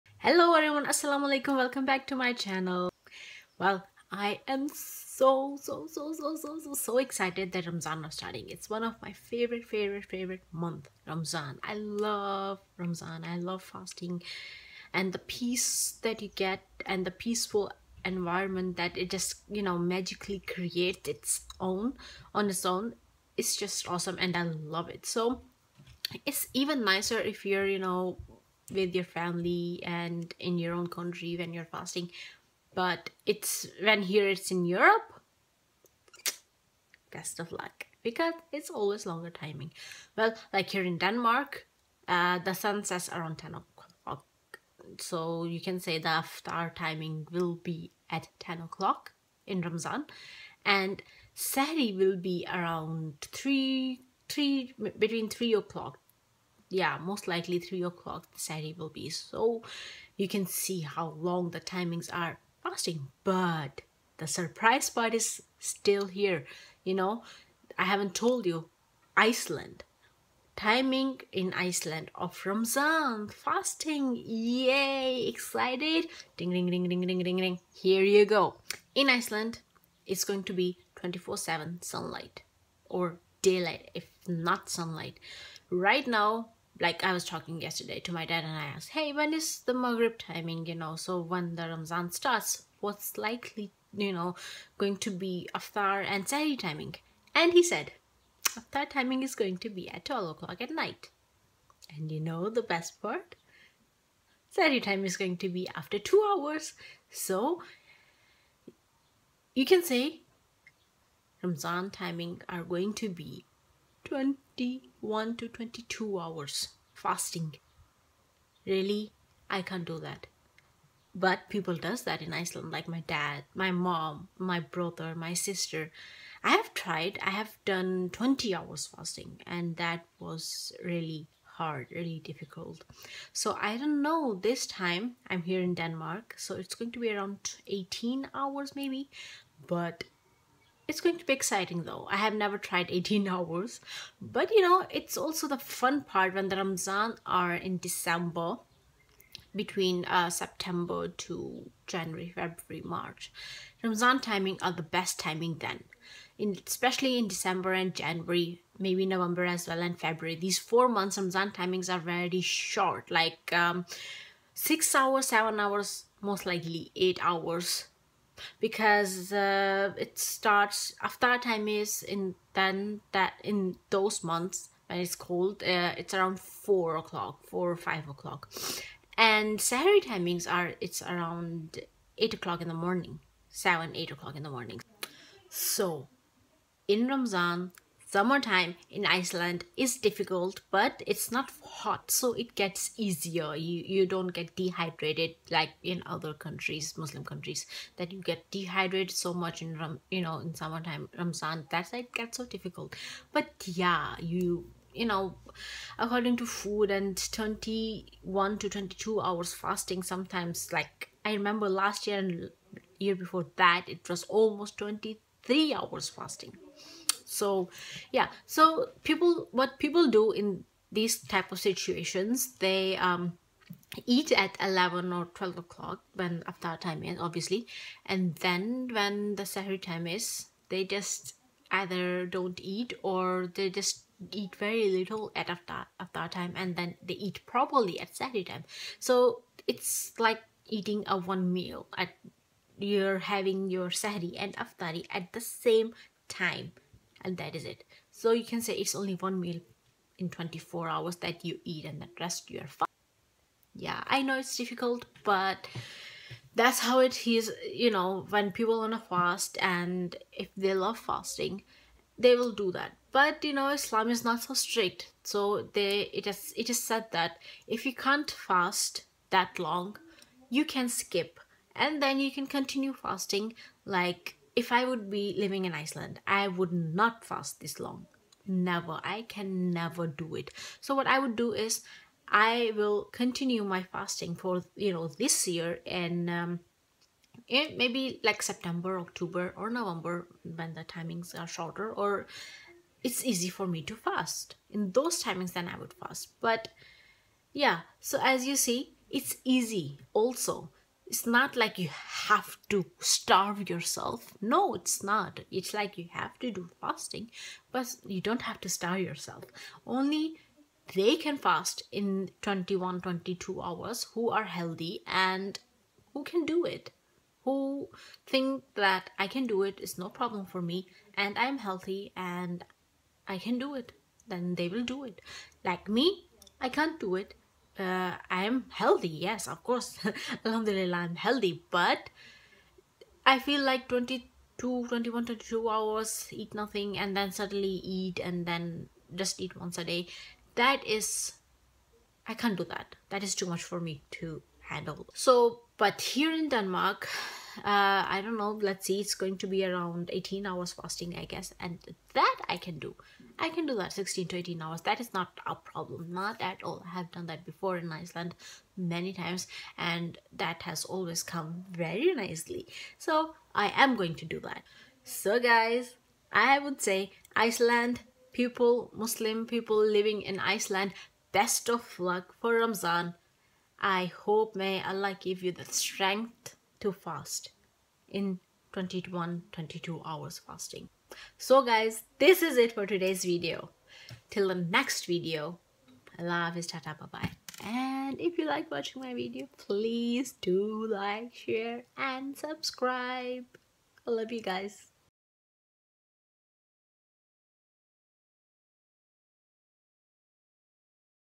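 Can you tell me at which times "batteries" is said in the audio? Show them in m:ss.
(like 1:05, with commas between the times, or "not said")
not said.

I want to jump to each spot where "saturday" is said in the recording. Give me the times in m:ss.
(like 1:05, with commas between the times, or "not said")
0:58, 2:59, 3:58.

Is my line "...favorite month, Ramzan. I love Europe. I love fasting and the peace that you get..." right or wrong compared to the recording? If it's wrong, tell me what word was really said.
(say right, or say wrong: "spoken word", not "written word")
wrong: "Ramzan", not "Europe".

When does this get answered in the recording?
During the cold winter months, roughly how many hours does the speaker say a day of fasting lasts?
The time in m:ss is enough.
2:44.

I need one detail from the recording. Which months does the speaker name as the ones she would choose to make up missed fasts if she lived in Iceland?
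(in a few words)
September, October or November.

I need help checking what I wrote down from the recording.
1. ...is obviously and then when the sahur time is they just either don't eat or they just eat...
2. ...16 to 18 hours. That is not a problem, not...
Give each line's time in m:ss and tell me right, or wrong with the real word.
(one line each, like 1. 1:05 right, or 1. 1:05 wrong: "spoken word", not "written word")
1. 3:47 right
2. 5:53 right.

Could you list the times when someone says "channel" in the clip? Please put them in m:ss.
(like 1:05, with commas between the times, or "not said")
0:02.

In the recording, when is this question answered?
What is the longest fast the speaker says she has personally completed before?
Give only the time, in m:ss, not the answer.
2:08.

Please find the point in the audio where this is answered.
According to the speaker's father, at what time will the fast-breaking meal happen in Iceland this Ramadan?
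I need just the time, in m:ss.
1:40.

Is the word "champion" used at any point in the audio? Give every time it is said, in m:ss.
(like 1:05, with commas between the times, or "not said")
not said.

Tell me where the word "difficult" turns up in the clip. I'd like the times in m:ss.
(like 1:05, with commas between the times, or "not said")
2:12, 3:09, 3:22, 4:14.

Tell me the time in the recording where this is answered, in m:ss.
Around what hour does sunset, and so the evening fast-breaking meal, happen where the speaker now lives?
0:48.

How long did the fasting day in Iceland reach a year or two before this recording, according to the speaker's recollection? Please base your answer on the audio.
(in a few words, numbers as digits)
23 hours.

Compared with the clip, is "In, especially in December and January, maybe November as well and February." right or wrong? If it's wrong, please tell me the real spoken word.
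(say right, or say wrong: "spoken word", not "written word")
right.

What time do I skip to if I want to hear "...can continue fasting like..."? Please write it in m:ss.
4:32.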